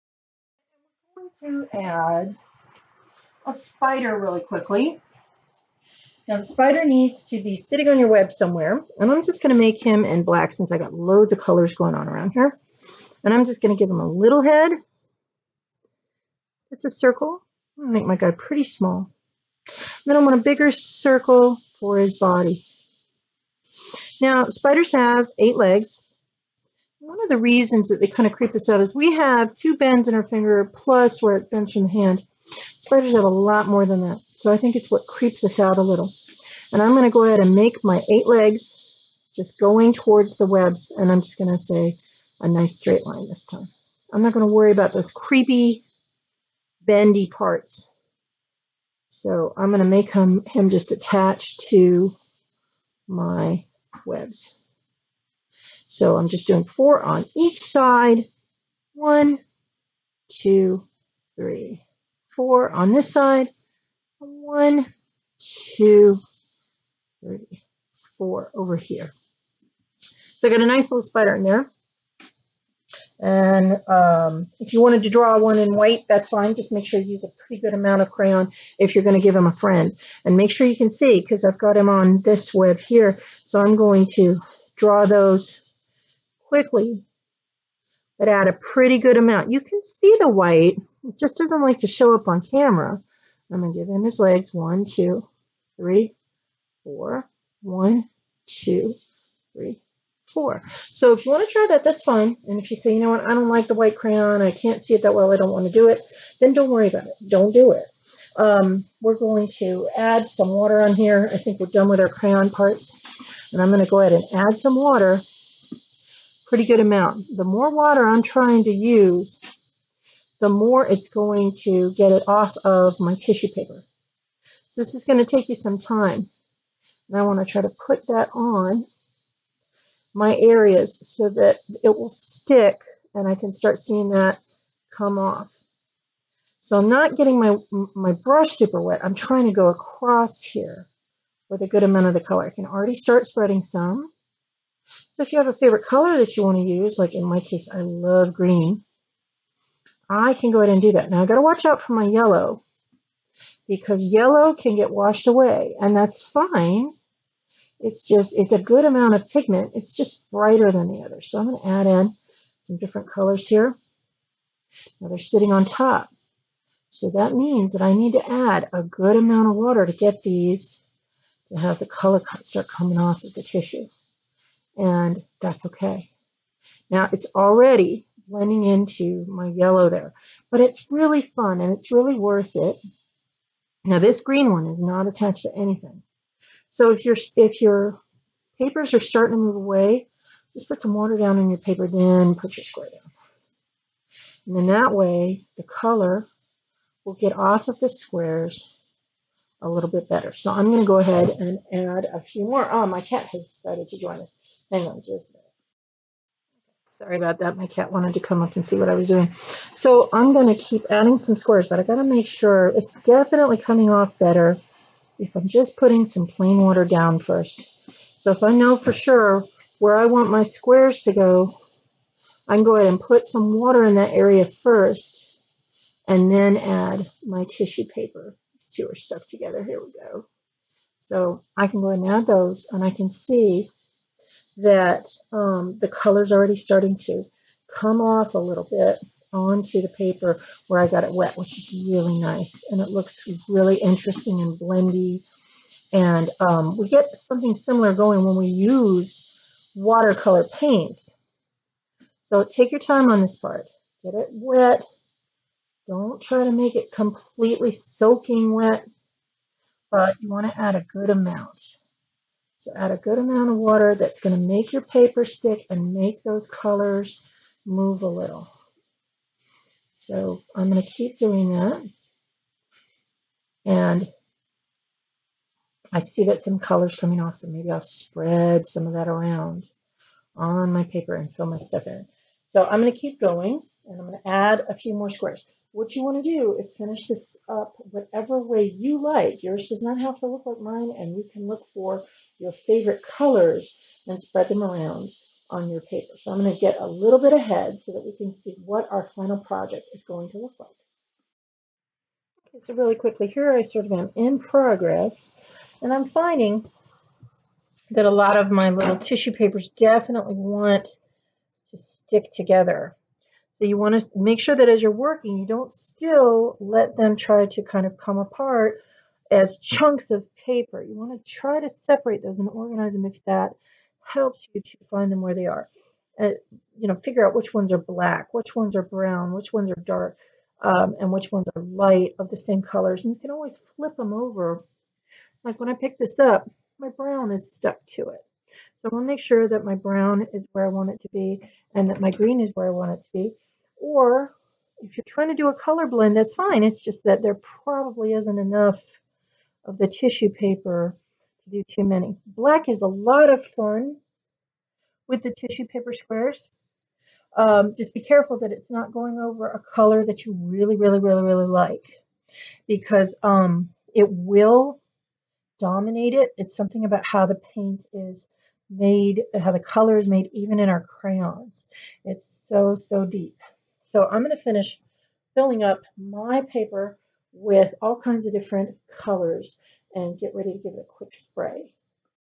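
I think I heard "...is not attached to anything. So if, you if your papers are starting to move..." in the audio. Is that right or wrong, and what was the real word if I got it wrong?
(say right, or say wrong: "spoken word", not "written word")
right.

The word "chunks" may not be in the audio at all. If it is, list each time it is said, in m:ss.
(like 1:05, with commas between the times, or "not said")
5:19.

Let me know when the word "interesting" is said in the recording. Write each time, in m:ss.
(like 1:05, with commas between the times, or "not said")
4:03.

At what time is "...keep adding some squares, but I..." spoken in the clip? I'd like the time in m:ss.
3:30.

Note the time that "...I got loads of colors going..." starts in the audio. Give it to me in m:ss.
0:10.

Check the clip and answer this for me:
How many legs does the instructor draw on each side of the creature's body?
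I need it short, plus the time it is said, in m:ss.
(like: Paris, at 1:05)
4, at 0:56.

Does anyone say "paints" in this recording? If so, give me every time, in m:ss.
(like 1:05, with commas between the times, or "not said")
4:10, 6:07.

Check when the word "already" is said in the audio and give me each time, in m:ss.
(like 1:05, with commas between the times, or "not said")
2:22, 2:57, 3:56.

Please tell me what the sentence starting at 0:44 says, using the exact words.
I'm not going to worry about those creepy, bendy parts.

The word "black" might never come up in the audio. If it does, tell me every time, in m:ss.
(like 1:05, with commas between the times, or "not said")
0:10, 5:27, 5:52.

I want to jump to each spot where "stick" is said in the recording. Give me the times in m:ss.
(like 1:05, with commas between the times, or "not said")
2:12, 4:25, 5:11.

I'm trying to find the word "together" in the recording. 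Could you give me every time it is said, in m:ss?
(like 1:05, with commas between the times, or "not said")
3:49, 5:12.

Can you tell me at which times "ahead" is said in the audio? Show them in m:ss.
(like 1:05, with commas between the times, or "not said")
0:37, 1:54, 2:30, 3:20, 3:42, 3:51, 4:57.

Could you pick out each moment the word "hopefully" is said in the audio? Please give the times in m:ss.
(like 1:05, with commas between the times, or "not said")
not said.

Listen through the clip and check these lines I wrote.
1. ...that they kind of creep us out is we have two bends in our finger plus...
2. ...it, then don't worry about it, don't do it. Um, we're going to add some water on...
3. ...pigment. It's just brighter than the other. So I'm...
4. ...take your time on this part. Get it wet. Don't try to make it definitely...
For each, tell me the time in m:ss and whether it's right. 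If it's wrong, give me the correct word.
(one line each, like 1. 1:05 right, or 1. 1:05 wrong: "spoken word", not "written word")
1. 0:27 right
2. 1:45 right
3. 2:39 right
4. 4:12 wrong: "completely", not "definitely".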